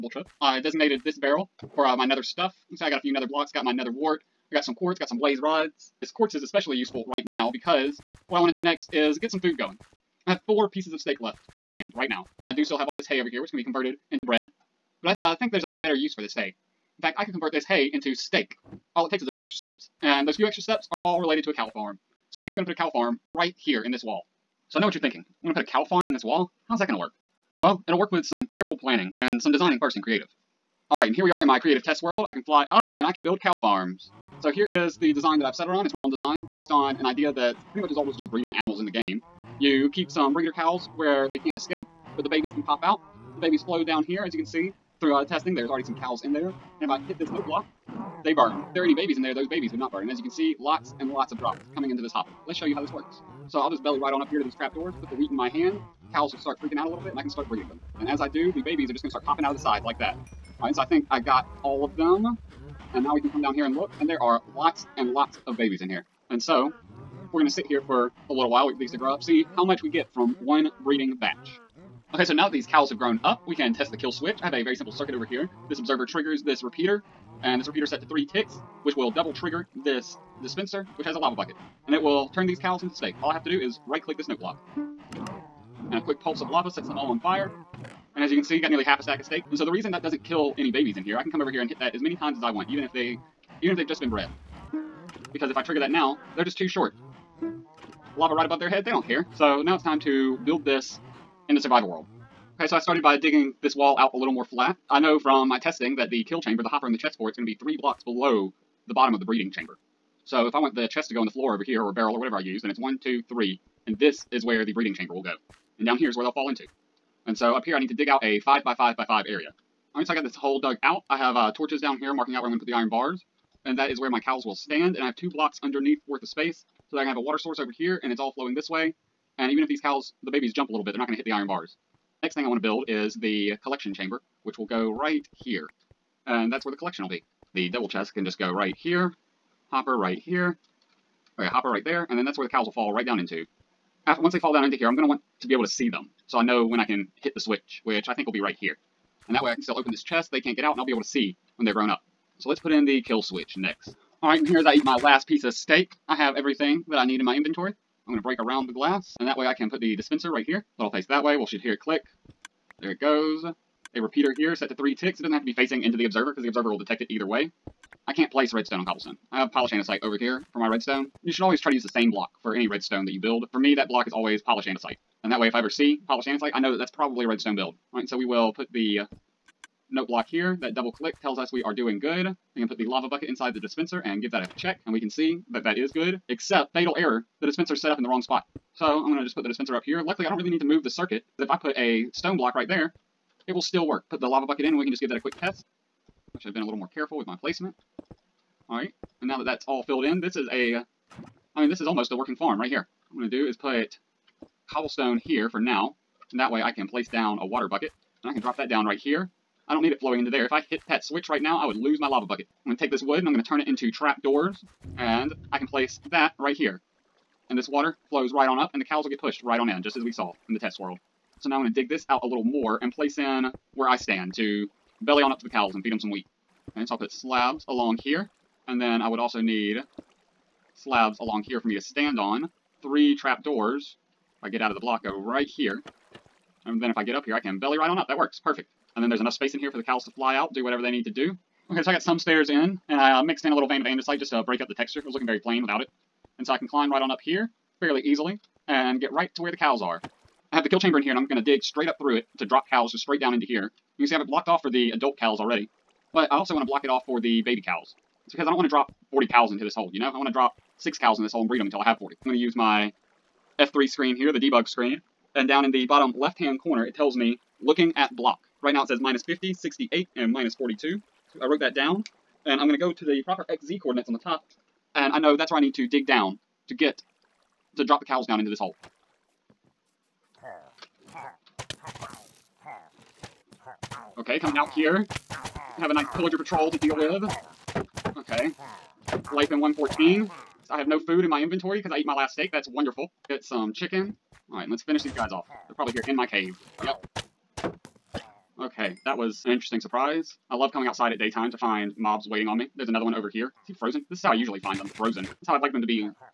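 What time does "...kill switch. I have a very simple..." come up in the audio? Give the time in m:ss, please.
1:13.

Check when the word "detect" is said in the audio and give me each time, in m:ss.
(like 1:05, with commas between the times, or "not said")
2:46.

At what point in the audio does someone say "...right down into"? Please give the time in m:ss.
2:22.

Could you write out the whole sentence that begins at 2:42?
There it goes a repeater here set to three ticks.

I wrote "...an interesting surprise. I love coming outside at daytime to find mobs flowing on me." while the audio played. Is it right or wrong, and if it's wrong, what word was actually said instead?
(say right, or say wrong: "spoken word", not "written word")
wrong: "waiting", not "flowing".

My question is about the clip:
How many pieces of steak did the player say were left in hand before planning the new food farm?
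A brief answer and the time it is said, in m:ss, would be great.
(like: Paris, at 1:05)
4, at 0:10.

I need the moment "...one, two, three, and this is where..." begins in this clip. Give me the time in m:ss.
1:52.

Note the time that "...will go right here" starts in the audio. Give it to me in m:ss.
2:14.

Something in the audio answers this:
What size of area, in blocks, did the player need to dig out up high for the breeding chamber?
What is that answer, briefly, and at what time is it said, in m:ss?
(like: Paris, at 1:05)
5 by 5 by 5, at 1:58.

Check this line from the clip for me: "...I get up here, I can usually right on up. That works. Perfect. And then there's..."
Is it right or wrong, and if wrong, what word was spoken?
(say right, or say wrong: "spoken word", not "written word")
wrong: "belly", not "usually".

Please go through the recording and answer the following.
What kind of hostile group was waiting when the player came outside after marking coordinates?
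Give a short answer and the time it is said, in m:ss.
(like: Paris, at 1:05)
Pillager patrol, at 4:46.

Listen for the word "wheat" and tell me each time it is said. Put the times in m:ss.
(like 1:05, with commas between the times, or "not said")
0:55, 3:46.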